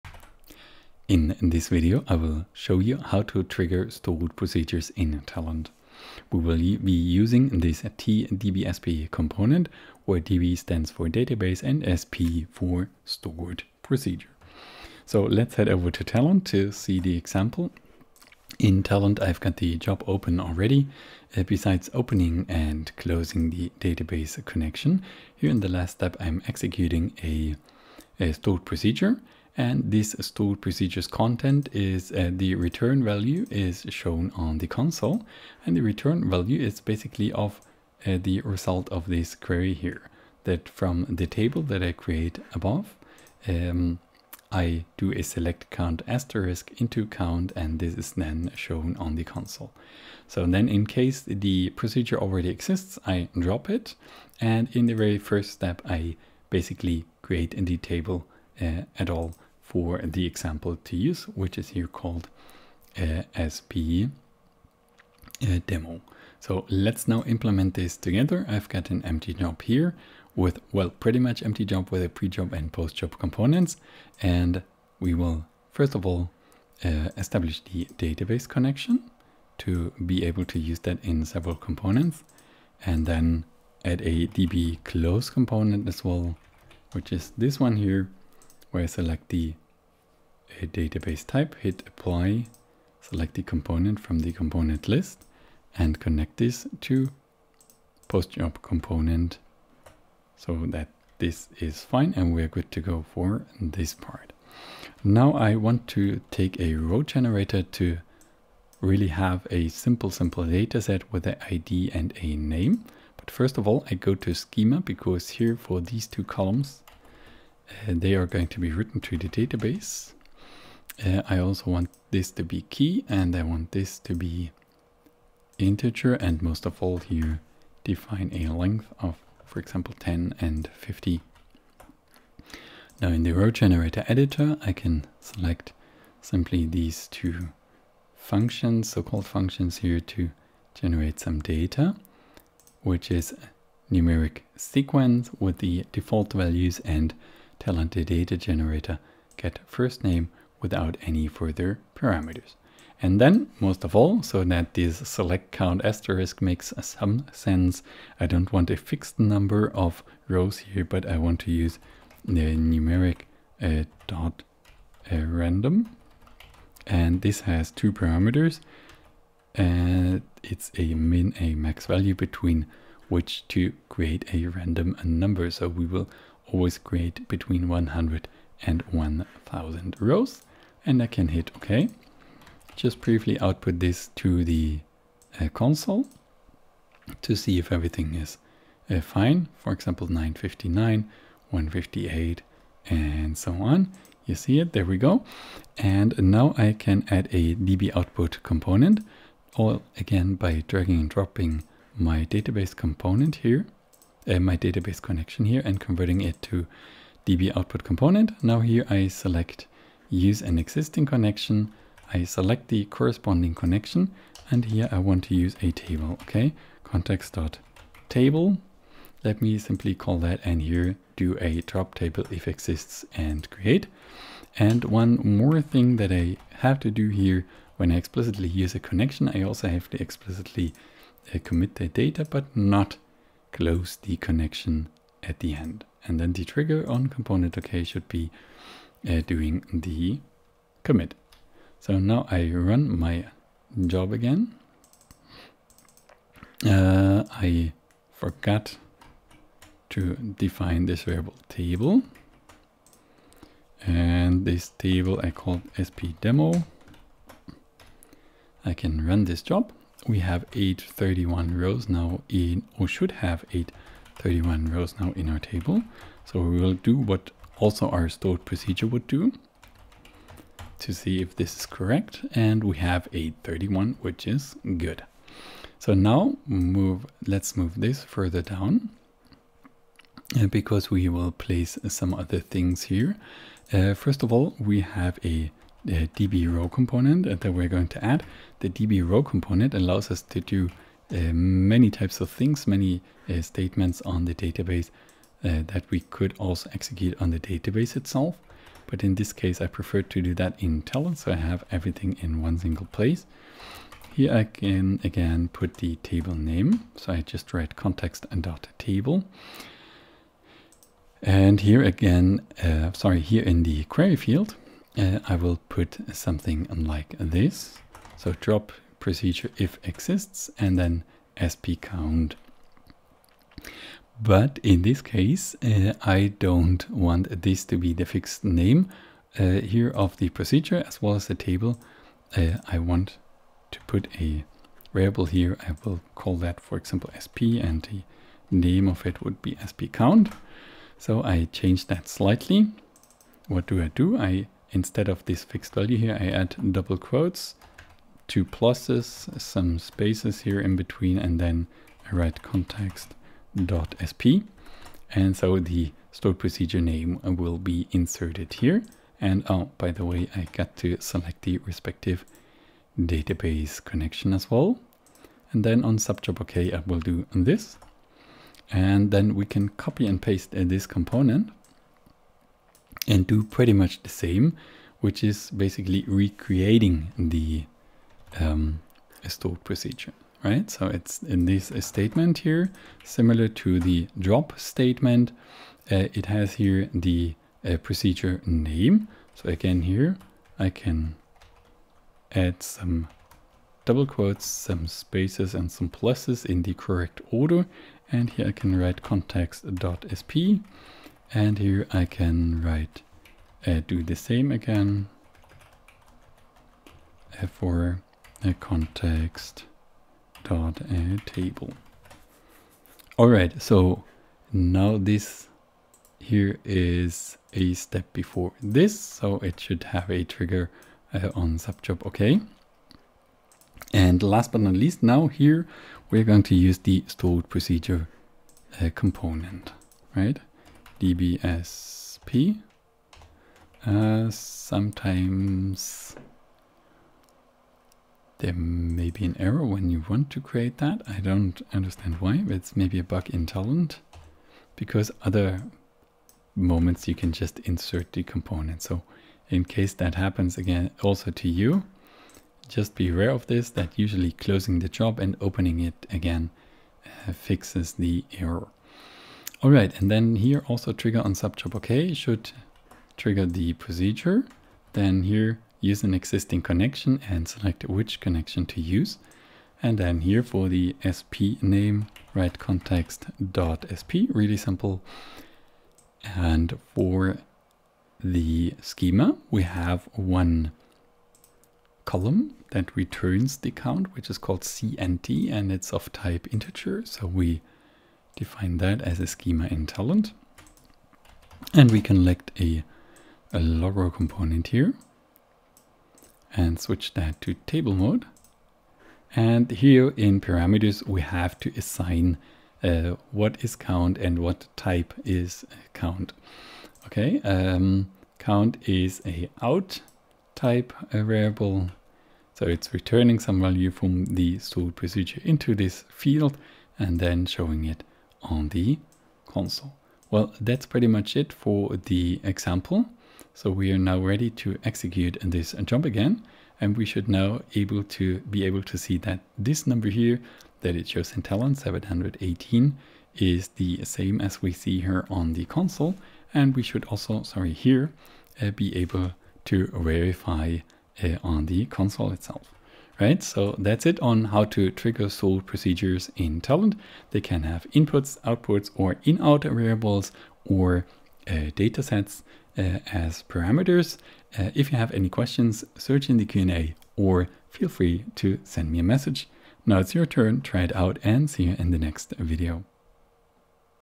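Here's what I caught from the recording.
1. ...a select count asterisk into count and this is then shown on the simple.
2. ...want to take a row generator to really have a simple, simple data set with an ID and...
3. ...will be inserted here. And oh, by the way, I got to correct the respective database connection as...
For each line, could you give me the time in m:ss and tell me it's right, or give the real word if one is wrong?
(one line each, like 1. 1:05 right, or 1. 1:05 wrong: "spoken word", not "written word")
1. 0:45 wrong: "console", not "simple"
2. 1:45 right
3. 5:57 wrong: "select", not "correct".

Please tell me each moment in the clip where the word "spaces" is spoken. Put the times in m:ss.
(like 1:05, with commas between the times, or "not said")
5:49, 6:34.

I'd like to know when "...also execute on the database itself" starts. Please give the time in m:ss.
4:56.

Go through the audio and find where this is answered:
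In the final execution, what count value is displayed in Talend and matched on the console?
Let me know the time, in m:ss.
8:51.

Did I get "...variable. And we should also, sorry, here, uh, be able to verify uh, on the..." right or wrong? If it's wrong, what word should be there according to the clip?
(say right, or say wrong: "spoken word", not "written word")
wrong: "console", not "variable".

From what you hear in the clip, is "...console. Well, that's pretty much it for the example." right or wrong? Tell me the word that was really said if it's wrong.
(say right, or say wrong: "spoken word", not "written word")
right.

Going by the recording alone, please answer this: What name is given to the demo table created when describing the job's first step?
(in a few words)
SP demo.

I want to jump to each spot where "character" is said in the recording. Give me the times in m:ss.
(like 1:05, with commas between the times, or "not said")
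not said.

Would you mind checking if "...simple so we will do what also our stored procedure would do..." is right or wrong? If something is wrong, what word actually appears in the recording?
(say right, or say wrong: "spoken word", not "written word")
wrong: "table", not "simple".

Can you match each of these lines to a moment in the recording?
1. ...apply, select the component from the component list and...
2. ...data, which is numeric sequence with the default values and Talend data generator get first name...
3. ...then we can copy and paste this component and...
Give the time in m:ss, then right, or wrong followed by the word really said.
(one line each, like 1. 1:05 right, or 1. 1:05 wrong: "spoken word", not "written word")
1. 1:31 right
2. 2:21 right
3. 6:09 right.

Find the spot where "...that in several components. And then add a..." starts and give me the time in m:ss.
1:20.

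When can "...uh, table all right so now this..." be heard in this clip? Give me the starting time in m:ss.
6:51.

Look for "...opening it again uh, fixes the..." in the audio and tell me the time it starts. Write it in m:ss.
7:35.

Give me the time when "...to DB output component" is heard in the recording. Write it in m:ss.
3:26.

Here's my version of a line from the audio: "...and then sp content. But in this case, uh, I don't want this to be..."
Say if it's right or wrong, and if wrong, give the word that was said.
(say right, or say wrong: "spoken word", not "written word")
wrong: "count", not "content".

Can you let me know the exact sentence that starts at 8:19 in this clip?
And here in parameters, we have to assign uh, what is count and what type is count.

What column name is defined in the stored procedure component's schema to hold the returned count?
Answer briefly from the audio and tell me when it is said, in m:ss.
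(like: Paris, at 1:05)
cnt, at 8:04.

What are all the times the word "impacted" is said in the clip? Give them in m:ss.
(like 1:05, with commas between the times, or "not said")
not said.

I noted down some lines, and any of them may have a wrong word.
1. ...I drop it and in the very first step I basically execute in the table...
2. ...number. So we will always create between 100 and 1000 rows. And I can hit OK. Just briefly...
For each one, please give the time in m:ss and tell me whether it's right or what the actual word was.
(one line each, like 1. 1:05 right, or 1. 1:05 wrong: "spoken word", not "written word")
1. 0:53 wrong: "create", not "execute"
2. 2:55 right.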